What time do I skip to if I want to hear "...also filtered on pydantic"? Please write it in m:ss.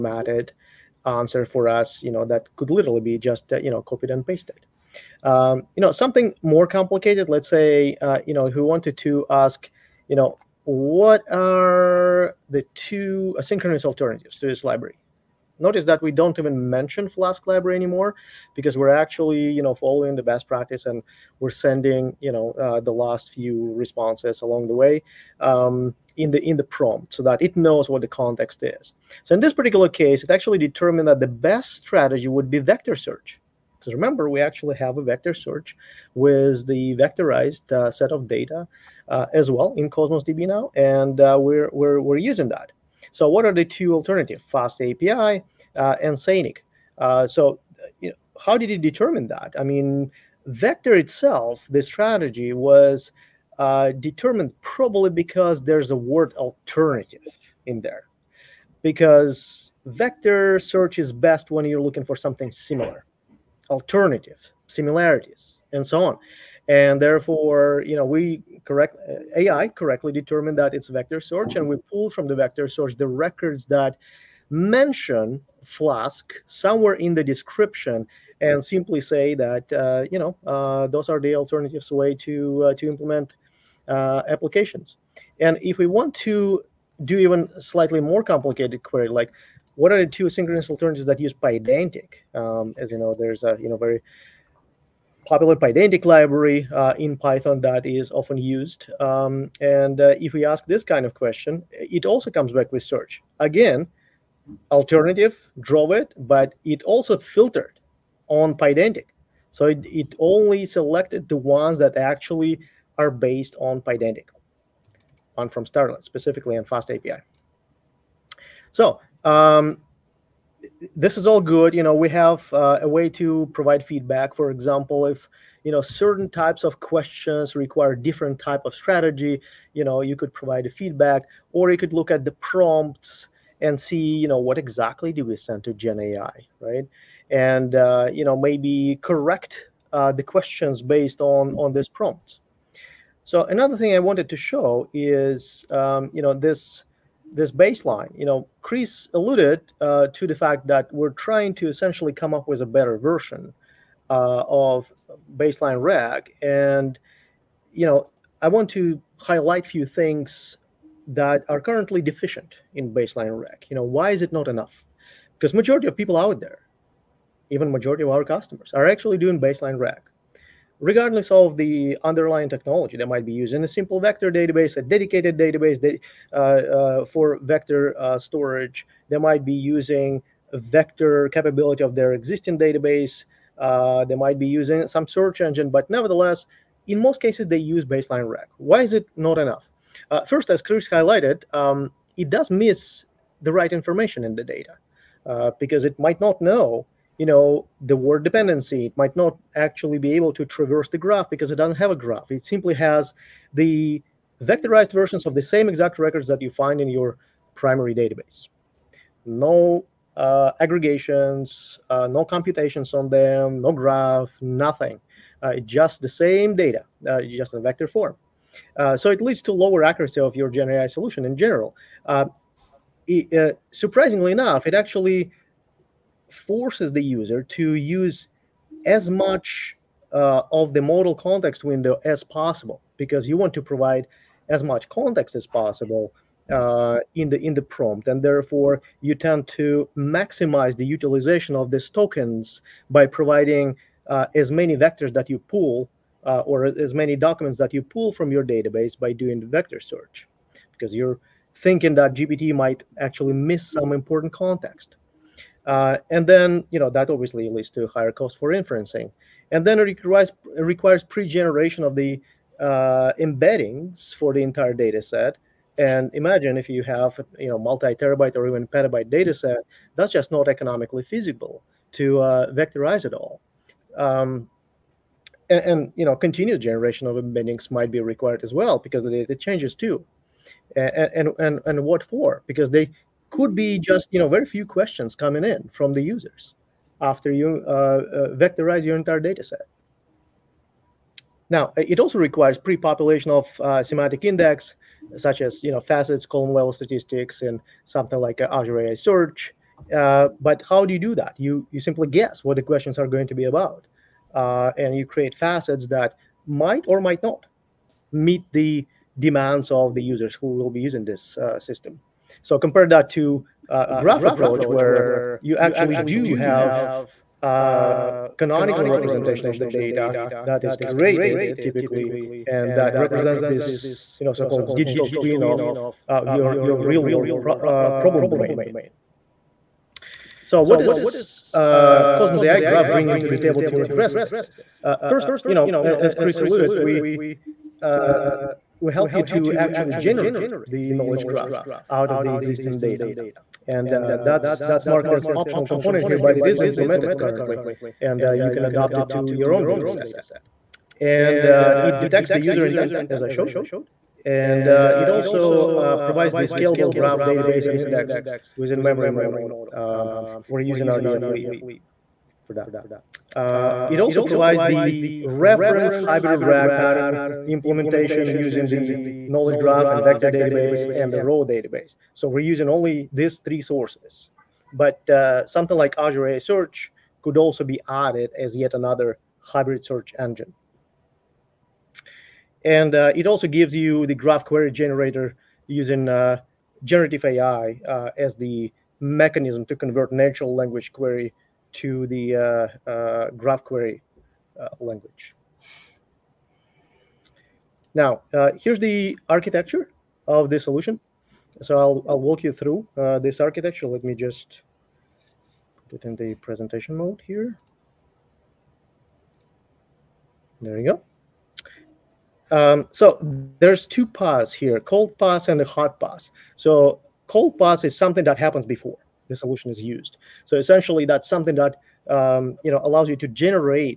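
1:46.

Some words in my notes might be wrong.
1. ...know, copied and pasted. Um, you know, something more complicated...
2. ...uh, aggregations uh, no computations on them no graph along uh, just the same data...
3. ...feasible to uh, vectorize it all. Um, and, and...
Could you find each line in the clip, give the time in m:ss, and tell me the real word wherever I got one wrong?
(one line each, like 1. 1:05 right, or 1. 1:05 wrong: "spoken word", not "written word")
1. 0:03 right
2. 3:30 wrong: "nothing", not "along"
3. 4:31 right.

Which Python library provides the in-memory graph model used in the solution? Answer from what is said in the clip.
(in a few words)
rdflib.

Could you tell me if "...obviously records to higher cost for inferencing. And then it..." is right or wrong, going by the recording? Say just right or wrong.
wrong.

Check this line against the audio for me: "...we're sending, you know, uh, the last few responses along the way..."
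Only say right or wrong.
right.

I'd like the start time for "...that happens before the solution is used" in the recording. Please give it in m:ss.
6:58.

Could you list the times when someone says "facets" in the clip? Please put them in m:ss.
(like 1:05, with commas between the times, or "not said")
4:55, 5:05.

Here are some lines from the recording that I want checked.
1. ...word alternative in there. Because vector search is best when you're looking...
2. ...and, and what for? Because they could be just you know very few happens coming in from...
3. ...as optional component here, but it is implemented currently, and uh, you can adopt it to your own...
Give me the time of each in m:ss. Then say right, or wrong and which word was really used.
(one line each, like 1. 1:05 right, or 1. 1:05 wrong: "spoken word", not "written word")
1. 0:55 right
2. 4:41 wrong: "questions", not "happens"
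3. 5:45 right.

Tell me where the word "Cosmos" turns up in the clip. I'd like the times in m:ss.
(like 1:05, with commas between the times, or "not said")
0:39, 5:32.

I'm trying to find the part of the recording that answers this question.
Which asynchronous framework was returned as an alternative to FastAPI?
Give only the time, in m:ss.
0:46.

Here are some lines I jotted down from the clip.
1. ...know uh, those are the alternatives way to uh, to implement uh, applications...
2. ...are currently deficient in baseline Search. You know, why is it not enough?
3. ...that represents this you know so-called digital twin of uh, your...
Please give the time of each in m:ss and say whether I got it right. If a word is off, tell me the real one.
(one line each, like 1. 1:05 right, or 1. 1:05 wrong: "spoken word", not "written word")
1. 1:20 right
2. 2:41 wrong: "RAG", not "Search"
3. 5:22 right.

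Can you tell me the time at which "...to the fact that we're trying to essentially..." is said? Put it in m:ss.
2:30.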